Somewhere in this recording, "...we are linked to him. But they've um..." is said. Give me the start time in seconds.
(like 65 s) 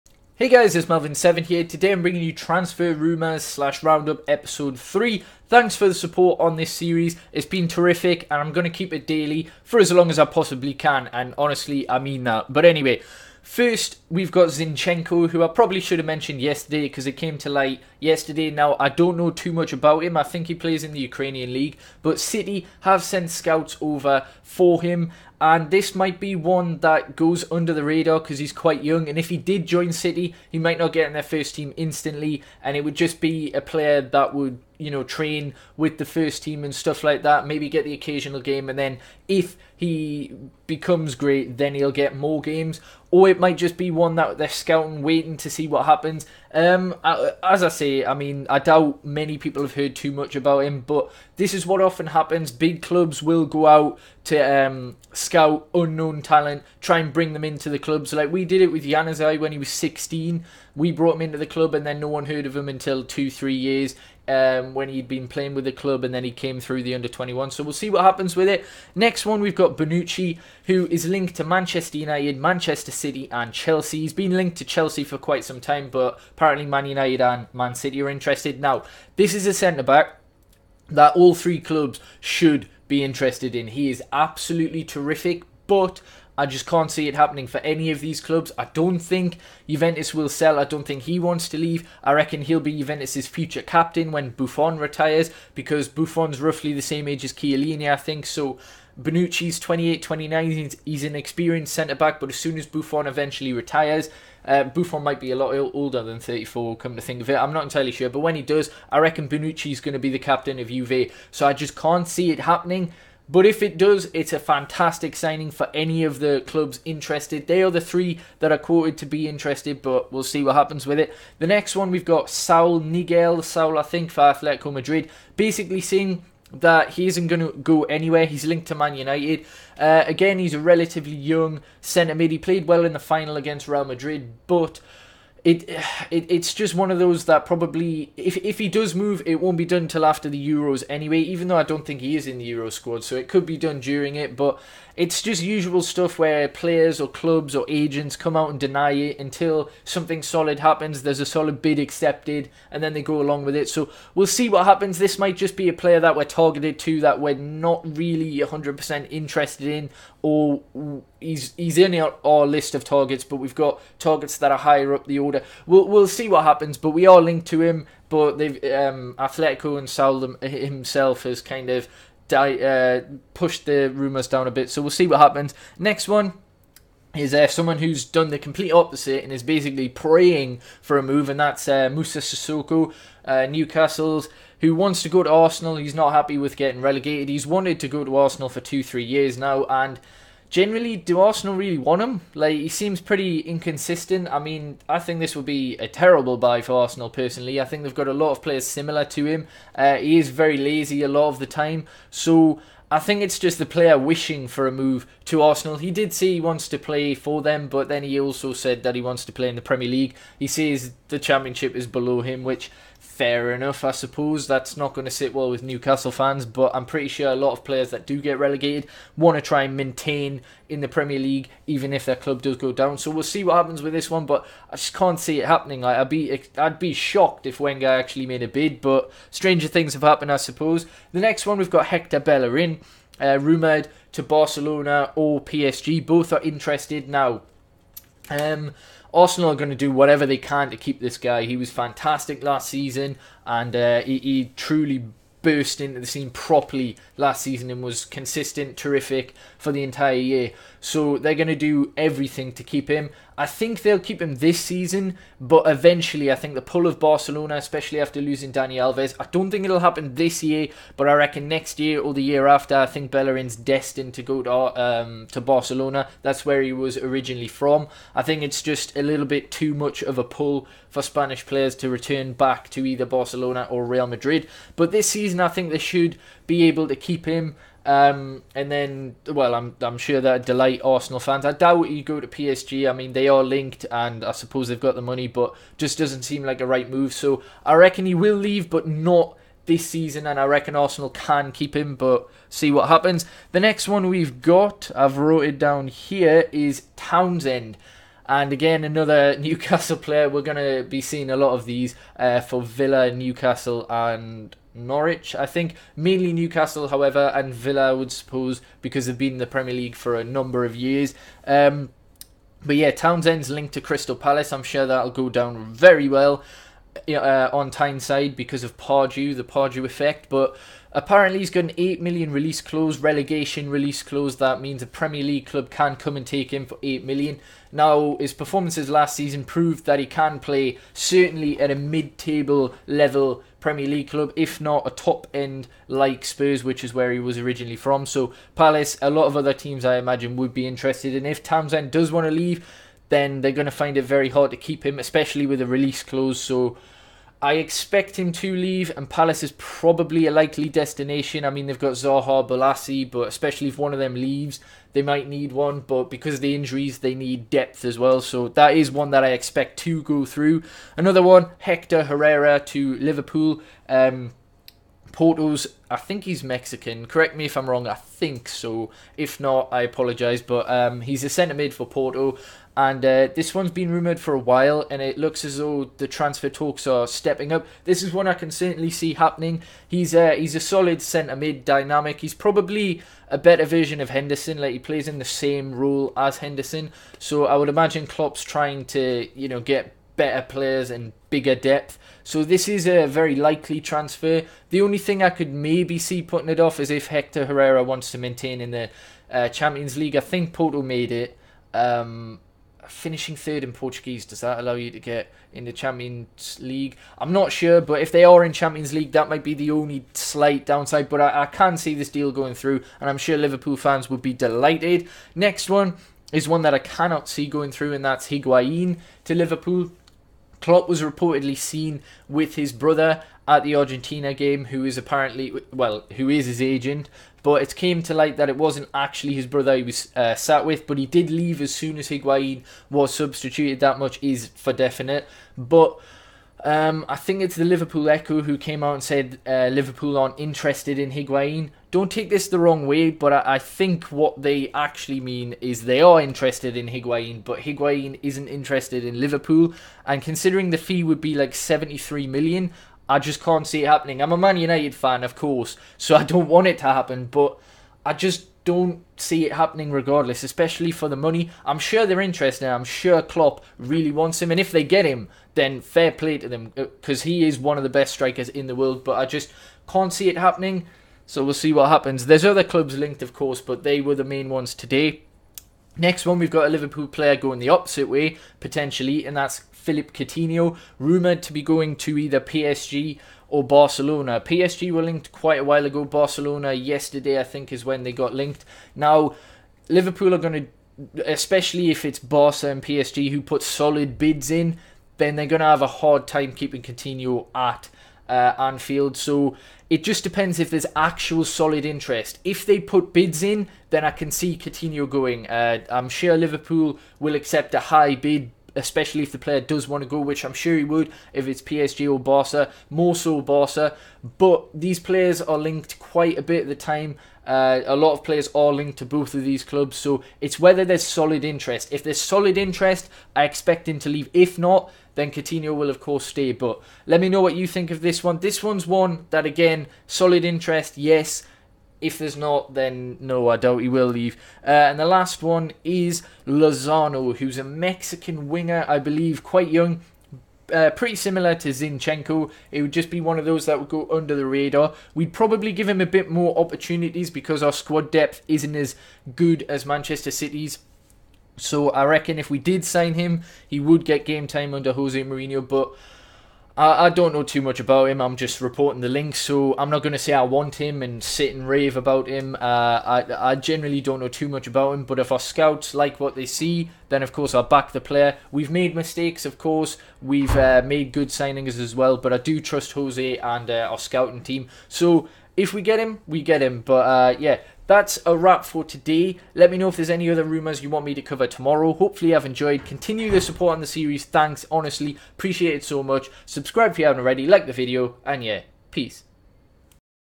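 166 s.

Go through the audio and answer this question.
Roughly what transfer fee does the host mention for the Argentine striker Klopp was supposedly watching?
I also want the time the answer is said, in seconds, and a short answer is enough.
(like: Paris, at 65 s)
73 million, at 451 s.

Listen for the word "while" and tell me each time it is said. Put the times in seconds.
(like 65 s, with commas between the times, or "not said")
374 s, 485 s.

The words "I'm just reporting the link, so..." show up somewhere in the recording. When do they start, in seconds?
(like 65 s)
558 s.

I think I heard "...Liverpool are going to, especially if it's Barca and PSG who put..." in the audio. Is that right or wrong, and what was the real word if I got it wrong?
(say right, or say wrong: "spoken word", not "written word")
right.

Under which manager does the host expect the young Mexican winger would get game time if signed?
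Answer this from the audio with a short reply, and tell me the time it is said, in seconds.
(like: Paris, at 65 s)
Jose Mourinho, at 554 s.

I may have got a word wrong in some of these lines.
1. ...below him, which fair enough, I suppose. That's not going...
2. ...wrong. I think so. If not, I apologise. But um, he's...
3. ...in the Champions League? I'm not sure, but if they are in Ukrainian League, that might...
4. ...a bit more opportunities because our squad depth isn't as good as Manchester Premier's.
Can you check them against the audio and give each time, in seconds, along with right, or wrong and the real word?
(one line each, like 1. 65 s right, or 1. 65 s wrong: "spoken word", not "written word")
1. 211 s right
2. 367 s right
3. 405 s wrong: "Champions", not "Ukrainian"
4. 546 s wrong: "City", not "Premier".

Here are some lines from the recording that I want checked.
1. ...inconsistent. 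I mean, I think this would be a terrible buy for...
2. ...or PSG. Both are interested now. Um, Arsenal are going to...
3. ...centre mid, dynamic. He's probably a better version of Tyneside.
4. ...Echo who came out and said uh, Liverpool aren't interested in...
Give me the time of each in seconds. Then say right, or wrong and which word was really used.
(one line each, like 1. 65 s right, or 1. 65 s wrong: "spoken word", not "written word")
1. 193 s right
2. 235 s right
3. 381 s wrong: "Henderson", not "Tyneside"
4. 438 s right.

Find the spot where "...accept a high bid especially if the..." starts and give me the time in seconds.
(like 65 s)
507 s.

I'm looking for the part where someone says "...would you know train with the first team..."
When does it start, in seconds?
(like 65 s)
34 s.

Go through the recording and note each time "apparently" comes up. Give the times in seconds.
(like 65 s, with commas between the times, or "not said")
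76 s, 320 s, 424 s.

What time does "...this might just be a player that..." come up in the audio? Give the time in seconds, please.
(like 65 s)
154 s.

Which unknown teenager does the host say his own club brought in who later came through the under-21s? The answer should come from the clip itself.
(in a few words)
Januzaj.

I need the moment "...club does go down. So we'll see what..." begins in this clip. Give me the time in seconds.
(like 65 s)
222 s.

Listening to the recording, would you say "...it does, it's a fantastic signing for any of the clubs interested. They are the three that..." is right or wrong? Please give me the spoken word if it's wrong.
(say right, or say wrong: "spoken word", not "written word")
right.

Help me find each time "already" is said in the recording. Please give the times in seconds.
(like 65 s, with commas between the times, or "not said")
587 s.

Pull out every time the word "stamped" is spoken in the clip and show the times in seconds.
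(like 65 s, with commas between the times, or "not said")
not said.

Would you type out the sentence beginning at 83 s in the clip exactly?
He is absolutely terrific, but I just can't see it happening for any of these clubs.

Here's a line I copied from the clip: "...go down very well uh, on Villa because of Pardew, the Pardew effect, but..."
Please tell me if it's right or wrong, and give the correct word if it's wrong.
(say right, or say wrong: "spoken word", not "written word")
wrong: "Tyneside", not "Villa".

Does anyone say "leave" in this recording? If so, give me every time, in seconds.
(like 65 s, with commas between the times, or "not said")
91 s, 288 s, 342 s, 348 s, 354 s, 431 s, 524 s, 534 s.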